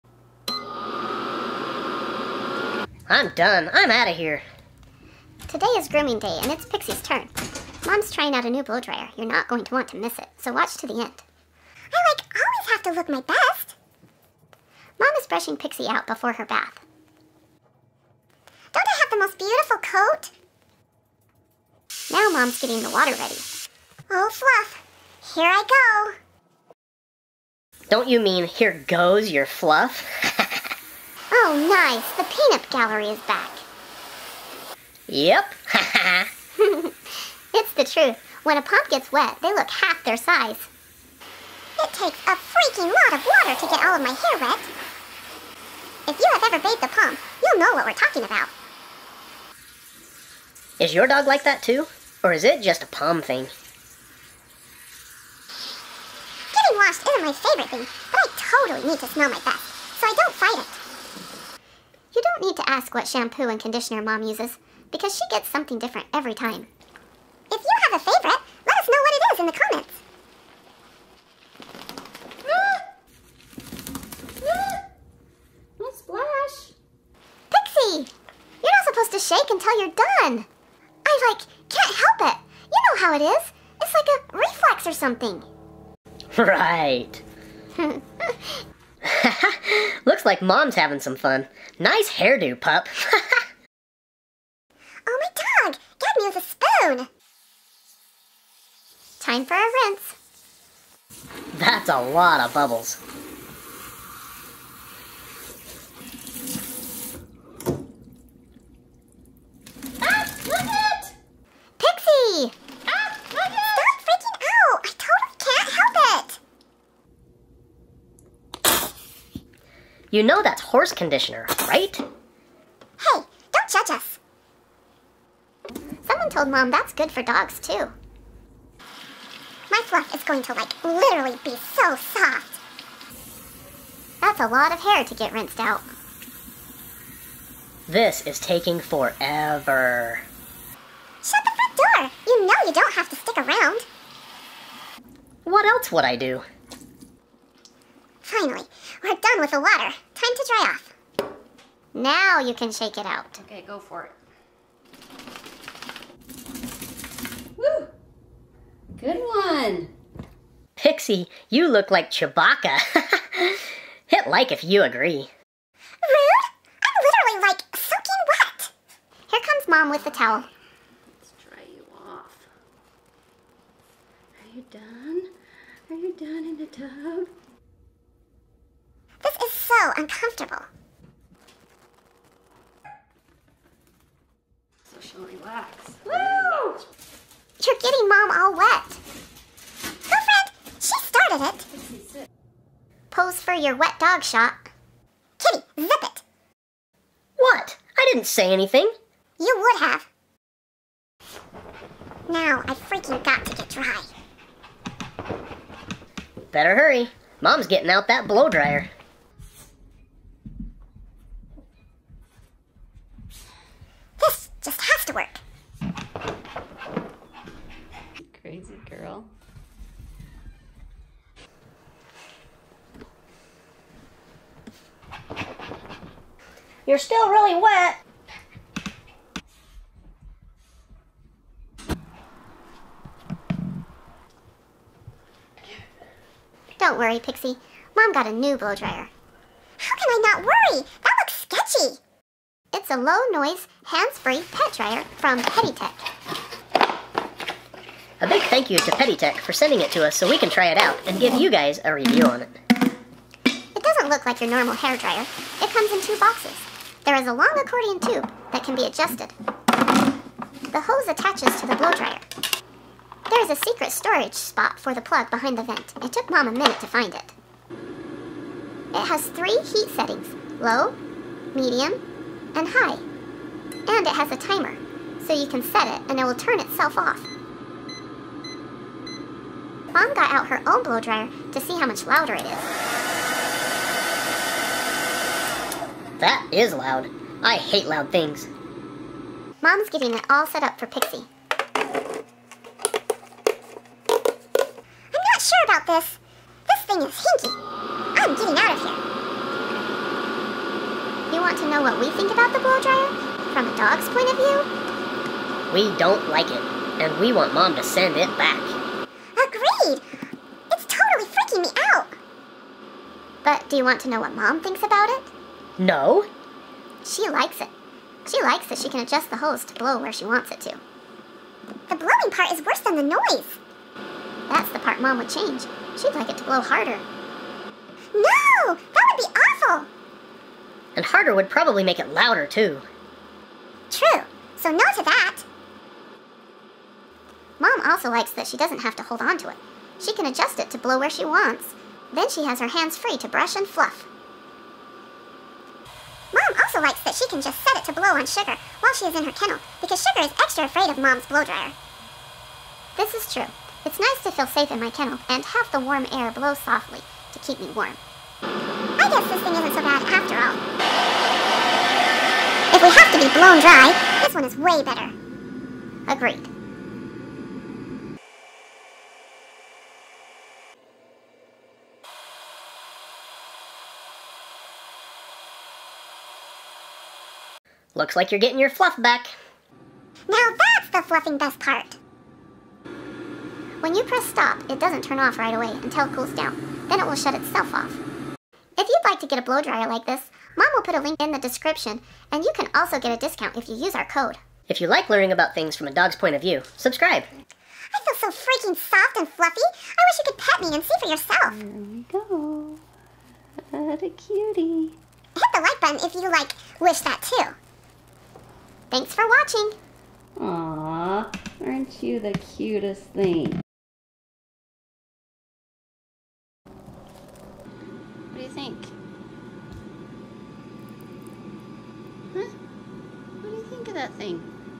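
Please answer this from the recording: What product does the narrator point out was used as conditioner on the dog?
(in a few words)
horse conditioner.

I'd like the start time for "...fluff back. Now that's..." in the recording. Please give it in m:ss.
6:18.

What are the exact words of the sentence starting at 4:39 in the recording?
Mom got out her own blow dryer to see how much louder it is.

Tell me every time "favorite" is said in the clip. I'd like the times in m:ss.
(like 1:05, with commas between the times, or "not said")
0:57, 1:08.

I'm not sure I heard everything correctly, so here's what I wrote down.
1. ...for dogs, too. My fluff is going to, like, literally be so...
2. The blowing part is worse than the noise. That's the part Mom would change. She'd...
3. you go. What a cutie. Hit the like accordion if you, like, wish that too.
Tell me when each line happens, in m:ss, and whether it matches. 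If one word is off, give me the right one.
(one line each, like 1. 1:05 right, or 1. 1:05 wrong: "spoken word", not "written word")
1. 2:07 right
2. 5:21 right
3. 6:41 wrong: "button", not "accordion".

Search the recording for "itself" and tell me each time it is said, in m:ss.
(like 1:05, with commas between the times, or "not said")
4:36, 6:27.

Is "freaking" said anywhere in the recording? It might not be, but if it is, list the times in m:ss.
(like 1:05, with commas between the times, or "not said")
0:42, 3:22, 5:11, 6:38.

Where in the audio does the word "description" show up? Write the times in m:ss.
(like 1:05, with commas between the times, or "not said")
6:31.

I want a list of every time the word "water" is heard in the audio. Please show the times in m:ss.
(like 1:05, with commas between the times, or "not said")
0:22, 0:43, 2:29.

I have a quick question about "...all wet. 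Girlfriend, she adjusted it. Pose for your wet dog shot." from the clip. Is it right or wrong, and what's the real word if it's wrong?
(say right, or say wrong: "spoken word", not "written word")
wrong: "started", not "adjusted".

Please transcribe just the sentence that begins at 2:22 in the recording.
You know you don't have to stick around.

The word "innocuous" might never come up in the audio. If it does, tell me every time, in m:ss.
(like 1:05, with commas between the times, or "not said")
not said.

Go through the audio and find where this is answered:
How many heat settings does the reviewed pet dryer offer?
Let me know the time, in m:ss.
4:29.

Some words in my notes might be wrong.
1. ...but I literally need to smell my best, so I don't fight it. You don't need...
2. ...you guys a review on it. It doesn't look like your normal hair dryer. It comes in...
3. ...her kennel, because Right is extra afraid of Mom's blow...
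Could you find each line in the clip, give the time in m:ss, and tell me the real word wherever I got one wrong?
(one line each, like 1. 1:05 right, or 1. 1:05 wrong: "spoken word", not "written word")
1. 0:58 wrong: "totally", not "literally"
2. 4:11 right
3. 5:49 wrong: "Sugar", not "Right".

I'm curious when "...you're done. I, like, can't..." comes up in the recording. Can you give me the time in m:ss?
1:19.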